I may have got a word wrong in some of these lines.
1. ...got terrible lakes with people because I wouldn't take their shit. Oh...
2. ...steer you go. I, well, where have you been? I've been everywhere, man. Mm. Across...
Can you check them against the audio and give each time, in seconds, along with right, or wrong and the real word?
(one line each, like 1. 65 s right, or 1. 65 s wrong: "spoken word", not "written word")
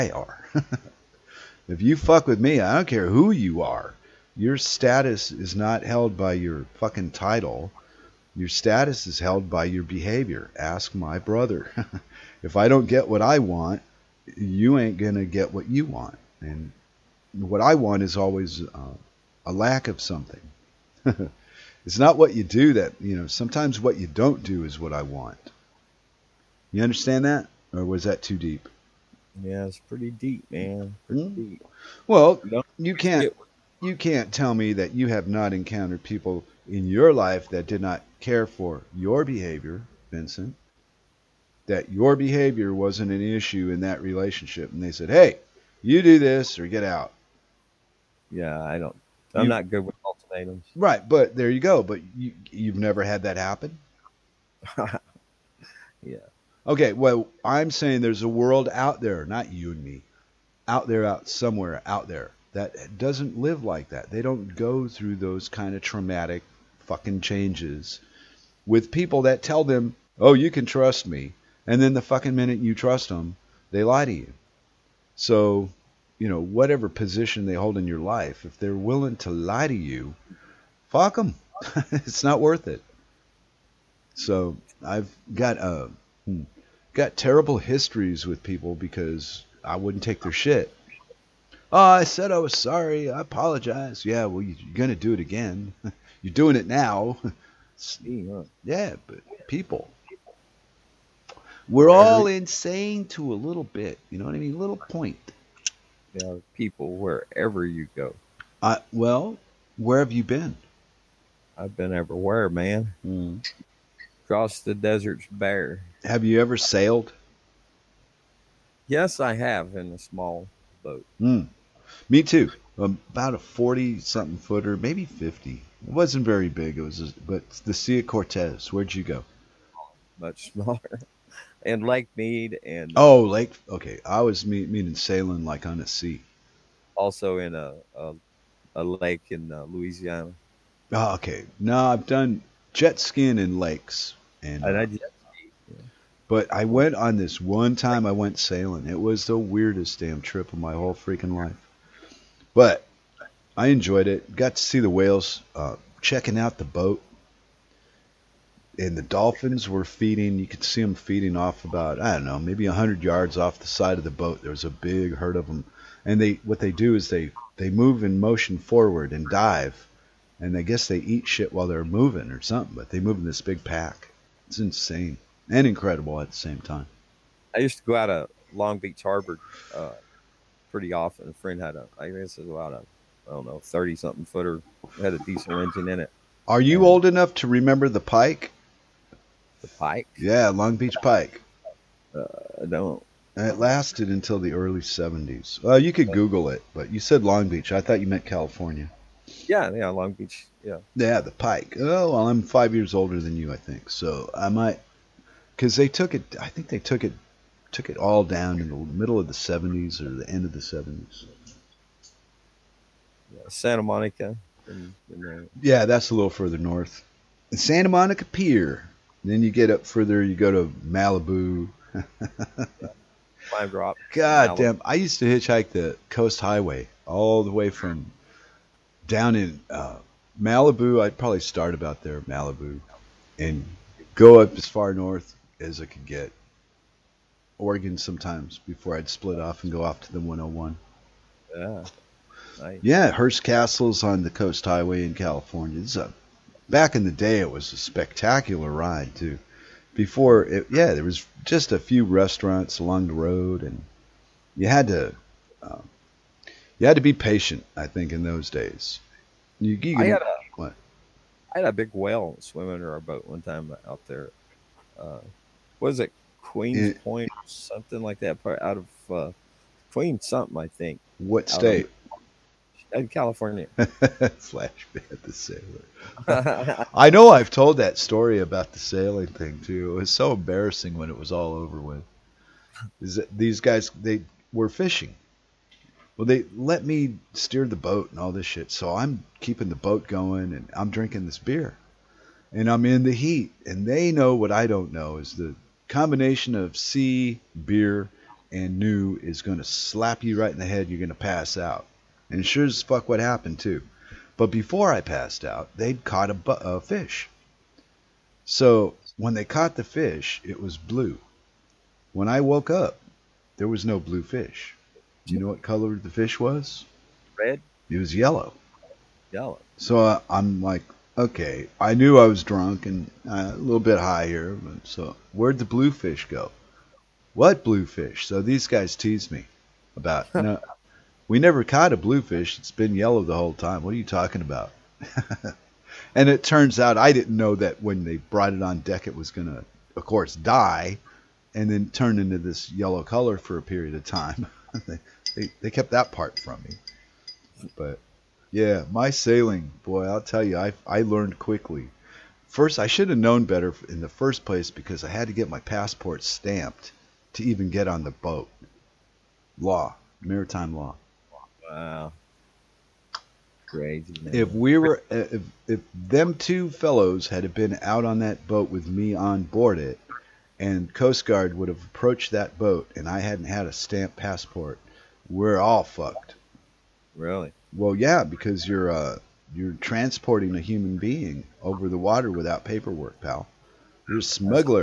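1. 86 s wrong: "histories", not "lakes"
2. 106 s wrong: "wherever", not "steer".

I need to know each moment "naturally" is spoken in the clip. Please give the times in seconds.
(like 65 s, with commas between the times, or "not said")
not said.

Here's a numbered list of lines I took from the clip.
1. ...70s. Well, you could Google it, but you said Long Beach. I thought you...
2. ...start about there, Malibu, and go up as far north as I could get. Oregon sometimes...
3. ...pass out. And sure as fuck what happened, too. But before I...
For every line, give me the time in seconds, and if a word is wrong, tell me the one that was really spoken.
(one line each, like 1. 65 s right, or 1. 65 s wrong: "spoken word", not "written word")
1. 194 s right
2. 231 s right
3. 301 s right.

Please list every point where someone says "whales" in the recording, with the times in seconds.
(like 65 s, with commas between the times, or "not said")
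154 s, 261 s.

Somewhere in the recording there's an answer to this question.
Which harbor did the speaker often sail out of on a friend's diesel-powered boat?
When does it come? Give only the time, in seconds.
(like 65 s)
178 s.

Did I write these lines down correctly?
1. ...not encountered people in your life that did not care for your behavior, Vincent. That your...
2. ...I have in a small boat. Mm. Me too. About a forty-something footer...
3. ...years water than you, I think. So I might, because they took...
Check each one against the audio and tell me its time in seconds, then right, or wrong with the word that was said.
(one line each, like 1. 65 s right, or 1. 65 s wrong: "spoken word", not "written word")
1. 35 s right
2. 119 s right
3. 202 s wrong: "older", not "water".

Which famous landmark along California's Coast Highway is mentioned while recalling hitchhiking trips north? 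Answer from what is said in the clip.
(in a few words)
Hearst Castle.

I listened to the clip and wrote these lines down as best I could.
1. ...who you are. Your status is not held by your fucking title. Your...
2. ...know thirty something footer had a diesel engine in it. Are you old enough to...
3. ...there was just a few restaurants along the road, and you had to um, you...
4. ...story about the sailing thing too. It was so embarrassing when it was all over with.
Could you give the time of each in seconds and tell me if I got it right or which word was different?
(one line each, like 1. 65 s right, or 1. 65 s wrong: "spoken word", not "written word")
1. 3 s right
2. 183 s right
3. 250 s right
4. 277 s right.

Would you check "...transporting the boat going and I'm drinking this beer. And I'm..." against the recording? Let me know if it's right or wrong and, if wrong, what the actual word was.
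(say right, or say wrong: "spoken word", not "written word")
wrong: "keeping", not "transporting".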